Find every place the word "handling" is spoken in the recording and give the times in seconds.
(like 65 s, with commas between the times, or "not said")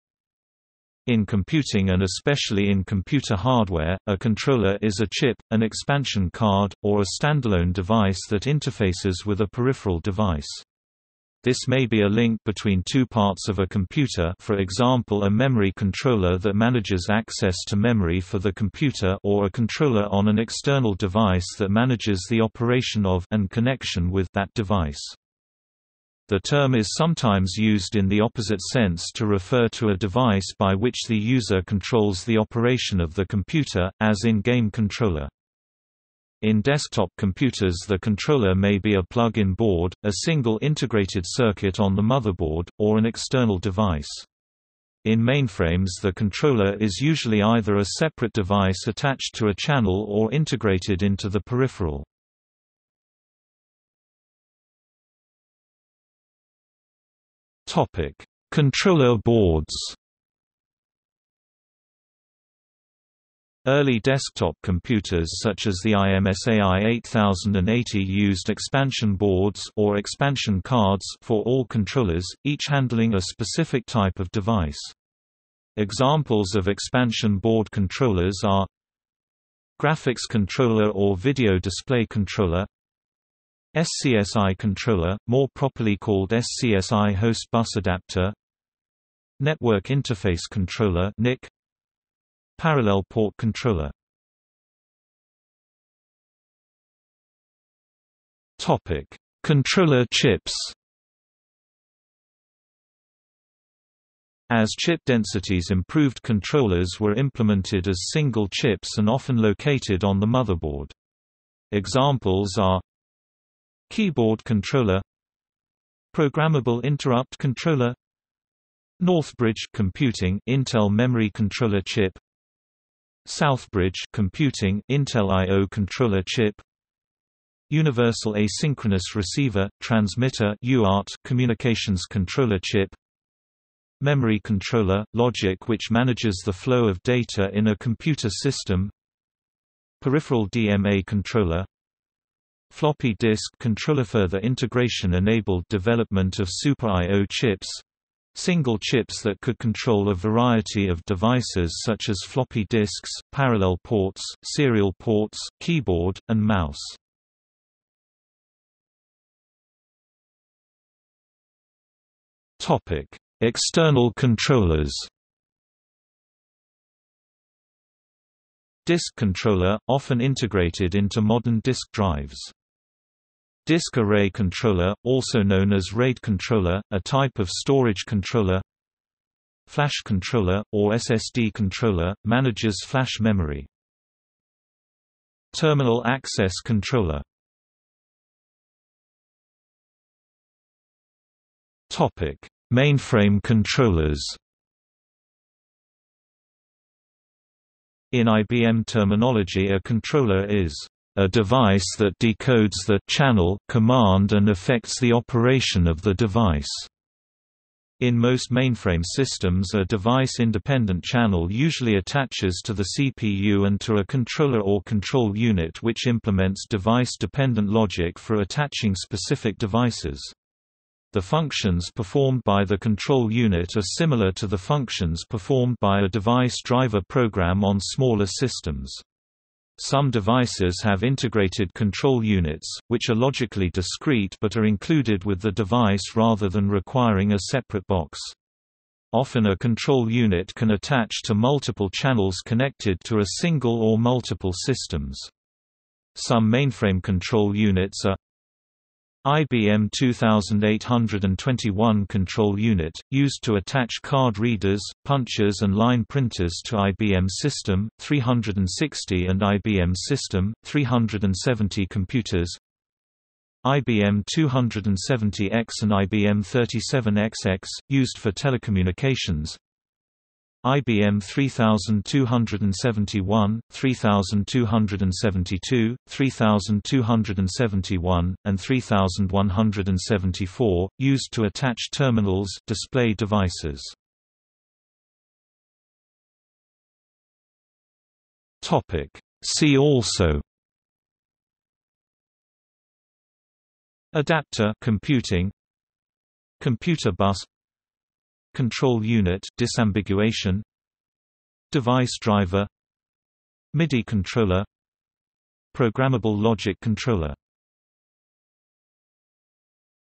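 72 s.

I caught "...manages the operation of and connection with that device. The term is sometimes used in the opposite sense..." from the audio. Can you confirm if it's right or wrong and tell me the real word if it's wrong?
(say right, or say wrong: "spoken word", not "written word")
right.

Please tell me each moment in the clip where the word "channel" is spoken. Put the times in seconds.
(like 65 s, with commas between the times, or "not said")
49 s, 203 s, 211 s, 241 s.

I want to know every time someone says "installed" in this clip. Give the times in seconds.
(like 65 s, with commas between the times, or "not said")
not said.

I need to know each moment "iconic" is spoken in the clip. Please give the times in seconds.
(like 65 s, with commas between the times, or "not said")
not said.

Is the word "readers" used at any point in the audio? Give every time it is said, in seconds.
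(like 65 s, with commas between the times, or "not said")
254 s.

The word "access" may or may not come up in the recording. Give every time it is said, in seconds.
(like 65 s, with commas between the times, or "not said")
17 s, 186 s.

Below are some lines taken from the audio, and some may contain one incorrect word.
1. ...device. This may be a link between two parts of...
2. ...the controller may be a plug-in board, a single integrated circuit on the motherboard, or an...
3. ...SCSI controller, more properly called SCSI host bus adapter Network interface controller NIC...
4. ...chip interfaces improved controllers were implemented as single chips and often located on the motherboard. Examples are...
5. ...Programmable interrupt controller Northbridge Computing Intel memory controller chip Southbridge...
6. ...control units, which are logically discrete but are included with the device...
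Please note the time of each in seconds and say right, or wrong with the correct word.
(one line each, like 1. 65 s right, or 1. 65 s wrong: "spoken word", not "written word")
1. 9 s right
2. 37 s right
3. 83 s right
4. 104 s wrong: "densities", not "interfaces"
5. 116 s right
6. 231 s right.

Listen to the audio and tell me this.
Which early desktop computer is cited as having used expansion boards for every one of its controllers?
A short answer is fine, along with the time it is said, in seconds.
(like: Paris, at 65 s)
IMSAI 8080, at 65 s.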